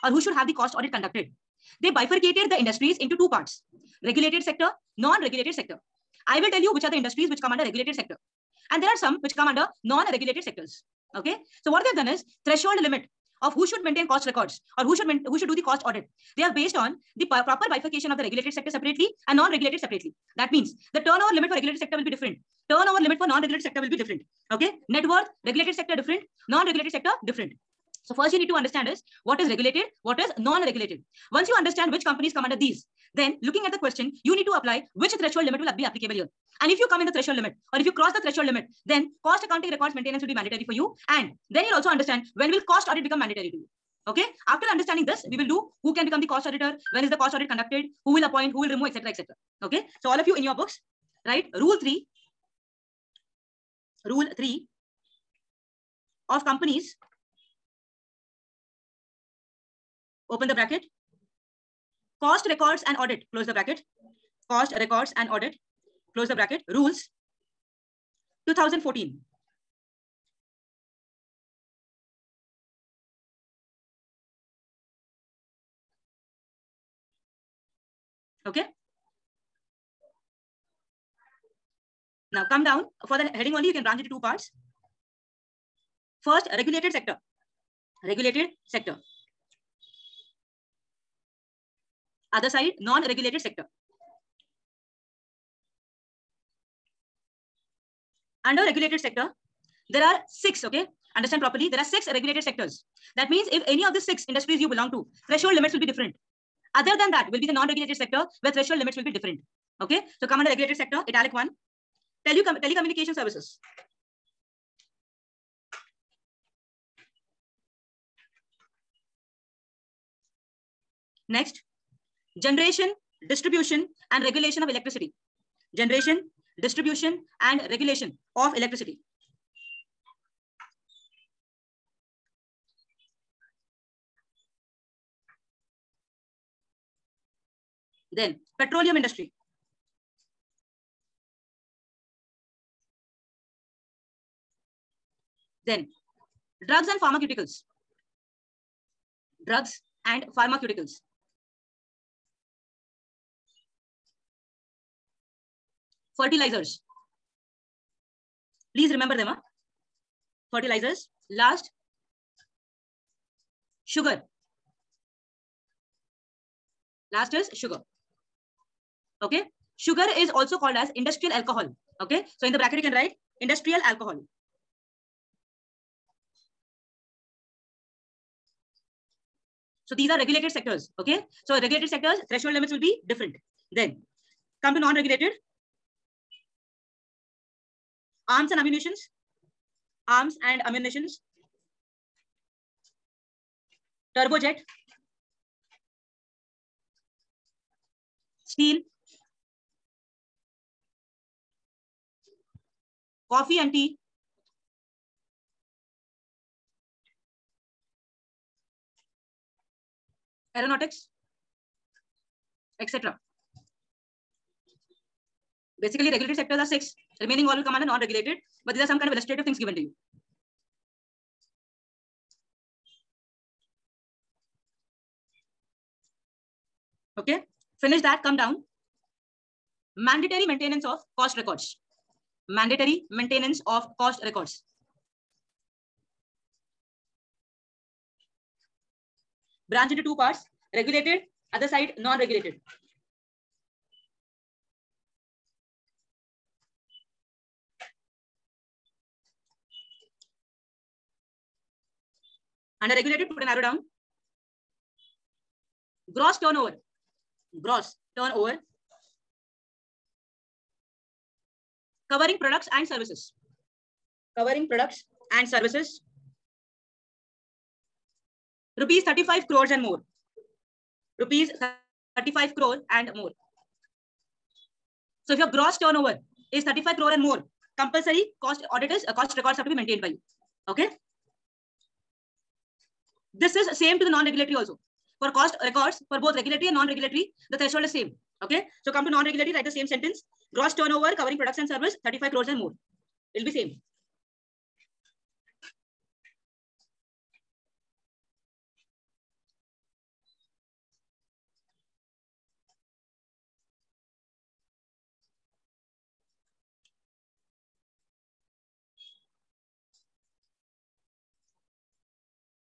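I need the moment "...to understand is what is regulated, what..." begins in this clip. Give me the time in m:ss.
0:28.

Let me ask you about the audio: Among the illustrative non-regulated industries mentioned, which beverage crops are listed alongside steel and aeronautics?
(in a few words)
Coffee and tea.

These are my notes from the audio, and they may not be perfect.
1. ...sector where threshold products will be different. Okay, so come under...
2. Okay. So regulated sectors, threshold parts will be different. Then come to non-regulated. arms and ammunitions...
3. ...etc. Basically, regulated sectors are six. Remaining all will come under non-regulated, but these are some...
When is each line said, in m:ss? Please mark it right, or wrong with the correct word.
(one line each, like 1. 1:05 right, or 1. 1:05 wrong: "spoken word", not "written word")
1. 1:47 wrong: "limits", not "products"
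2. 3:00 wrong: "limits", not "parts"
3. 3:32 right.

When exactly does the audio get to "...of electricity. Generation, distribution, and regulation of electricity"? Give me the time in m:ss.
2:04.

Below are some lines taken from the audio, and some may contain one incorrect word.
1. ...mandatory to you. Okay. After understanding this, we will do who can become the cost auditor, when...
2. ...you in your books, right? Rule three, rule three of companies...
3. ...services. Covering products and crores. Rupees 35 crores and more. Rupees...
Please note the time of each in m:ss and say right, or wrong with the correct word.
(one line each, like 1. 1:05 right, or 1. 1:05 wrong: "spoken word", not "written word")
1. 0:43 right
2. 0:50 right
3. 4:22 wrong: "services", not "crores".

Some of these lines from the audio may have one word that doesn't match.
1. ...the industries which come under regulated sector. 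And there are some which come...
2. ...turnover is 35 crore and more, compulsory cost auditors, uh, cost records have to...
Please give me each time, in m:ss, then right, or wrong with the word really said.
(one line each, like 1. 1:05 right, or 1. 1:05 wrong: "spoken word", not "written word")
1. 0:06 right
2. 4:35 right.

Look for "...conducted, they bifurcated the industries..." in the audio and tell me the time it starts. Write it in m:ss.
0:00.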